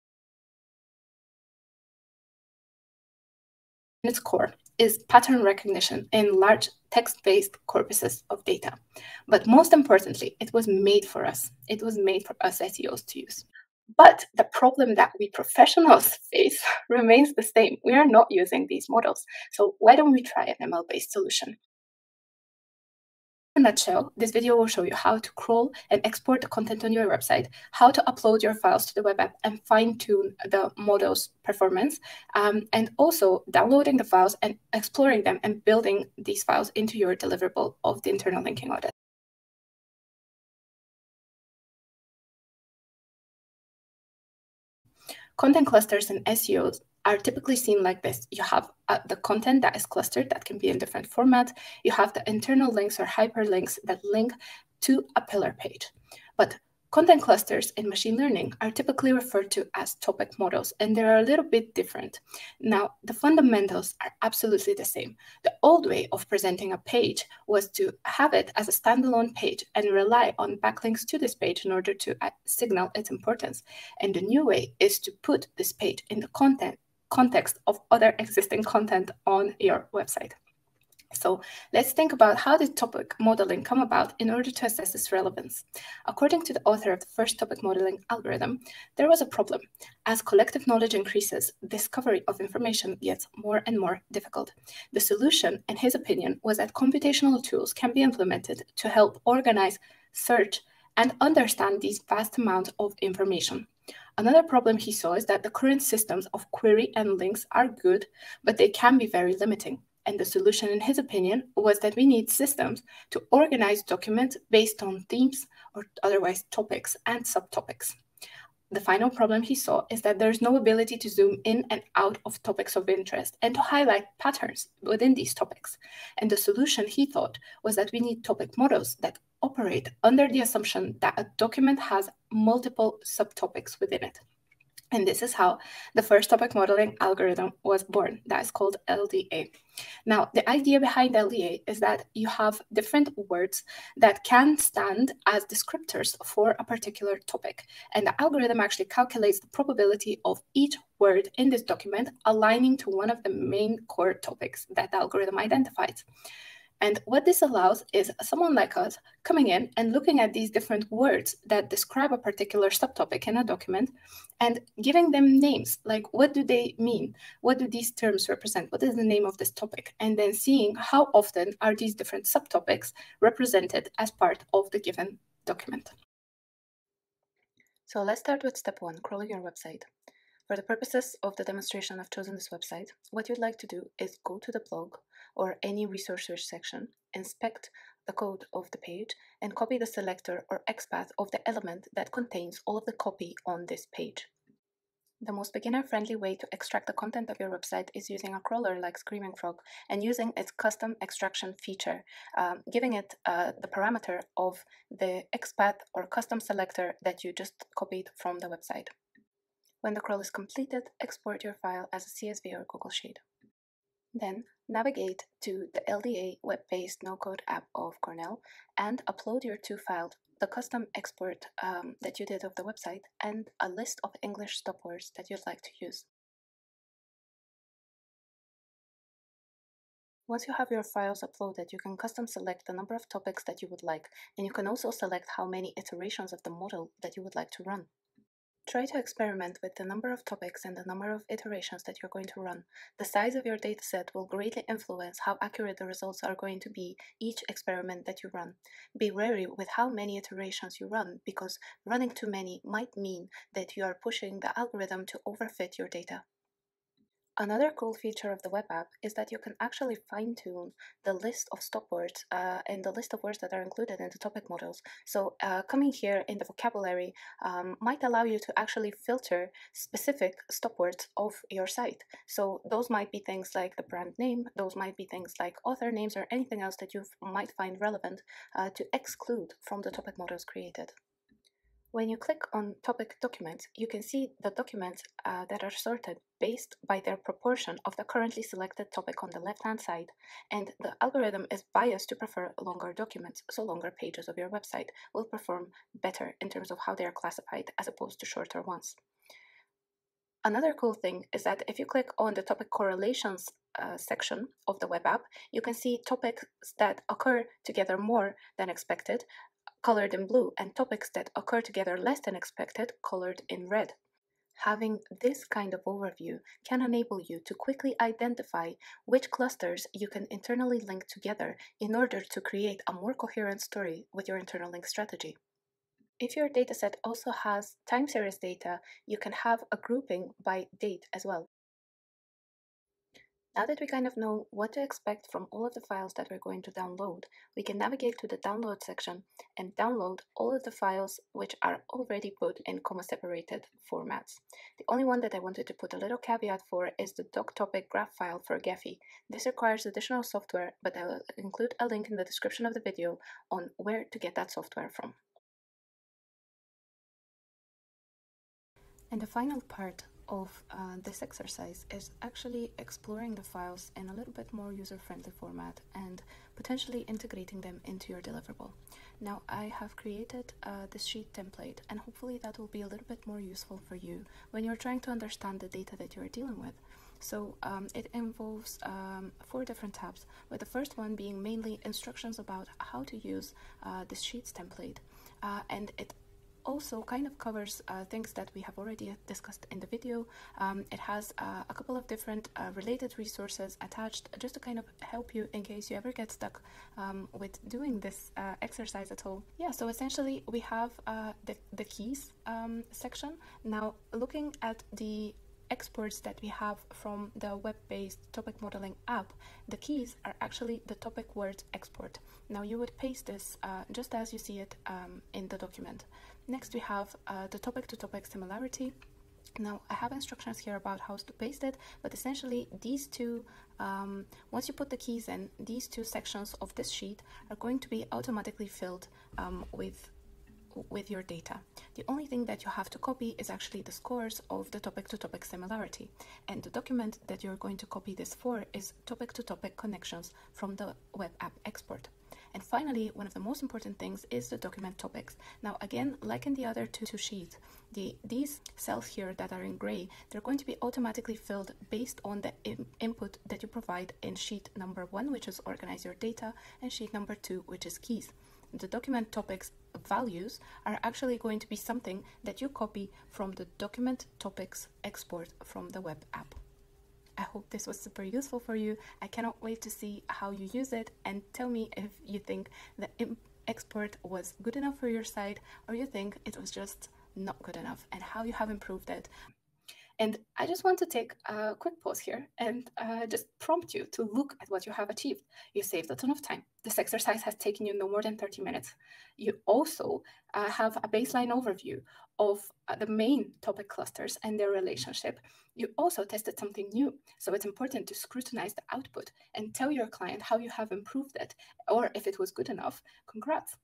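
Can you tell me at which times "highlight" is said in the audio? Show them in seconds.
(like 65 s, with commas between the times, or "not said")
123 s.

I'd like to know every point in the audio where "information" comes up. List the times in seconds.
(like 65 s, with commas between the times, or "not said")
92 s, 103 s.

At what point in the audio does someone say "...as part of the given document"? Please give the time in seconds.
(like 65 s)
173 s.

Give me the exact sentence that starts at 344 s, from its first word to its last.
The only one that I wanted to put a little caveat for is the doctopic graph file for Gephi.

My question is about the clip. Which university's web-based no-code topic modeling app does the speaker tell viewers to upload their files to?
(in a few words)
Cornell.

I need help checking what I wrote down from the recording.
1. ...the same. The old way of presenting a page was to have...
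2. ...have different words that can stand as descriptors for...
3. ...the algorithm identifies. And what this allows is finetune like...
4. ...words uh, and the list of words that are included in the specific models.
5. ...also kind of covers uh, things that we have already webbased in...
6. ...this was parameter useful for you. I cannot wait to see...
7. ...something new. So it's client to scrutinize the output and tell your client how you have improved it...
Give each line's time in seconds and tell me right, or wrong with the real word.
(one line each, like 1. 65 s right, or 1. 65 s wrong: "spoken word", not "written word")
1. 64 s right
2. 142 s right
3. 154 s wrong: "someone", not "finetune"
4. 261 s wrong: "topic", not "specific"
5. 386 s wrong: "discussed", not "webbased"
6. 467 s wrong: "super", not "parameter"
7. 496 s wrong: "important", not "client".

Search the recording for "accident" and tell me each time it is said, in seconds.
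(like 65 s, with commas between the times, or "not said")
not said.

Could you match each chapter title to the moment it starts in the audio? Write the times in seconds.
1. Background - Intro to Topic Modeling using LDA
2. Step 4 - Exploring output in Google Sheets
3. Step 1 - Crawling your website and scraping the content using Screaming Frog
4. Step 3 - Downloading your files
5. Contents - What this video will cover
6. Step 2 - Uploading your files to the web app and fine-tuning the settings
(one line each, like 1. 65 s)
1. 39 s
2. 358 s
3. 175 s
4. 330 s
5. 20 s
6. 225 s.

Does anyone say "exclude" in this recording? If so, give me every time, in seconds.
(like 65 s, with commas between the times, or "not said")
278 s.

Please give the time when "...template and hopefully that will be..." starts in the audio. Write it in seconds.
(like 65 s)
371 s.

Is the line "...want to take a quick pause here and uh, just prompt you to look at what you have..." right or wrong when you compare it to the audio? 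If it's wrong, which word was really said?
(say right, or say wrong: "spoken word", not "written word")
right.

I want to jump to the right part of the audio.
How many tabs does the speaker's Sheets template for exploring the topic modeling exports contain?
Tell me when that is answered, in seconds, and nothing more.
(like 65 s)
379 s.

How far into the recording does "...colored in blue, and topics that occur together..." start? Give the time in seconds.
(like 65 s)
309 s.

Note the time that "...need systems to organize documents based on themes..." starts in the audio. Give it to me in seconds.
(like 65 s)
112 s.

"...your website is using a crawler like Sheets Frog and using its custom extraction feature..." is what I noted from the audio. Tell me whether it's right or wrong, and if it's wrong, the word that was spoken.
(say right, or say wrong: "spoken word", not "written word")
wrong: "Screaming", not "Sheets".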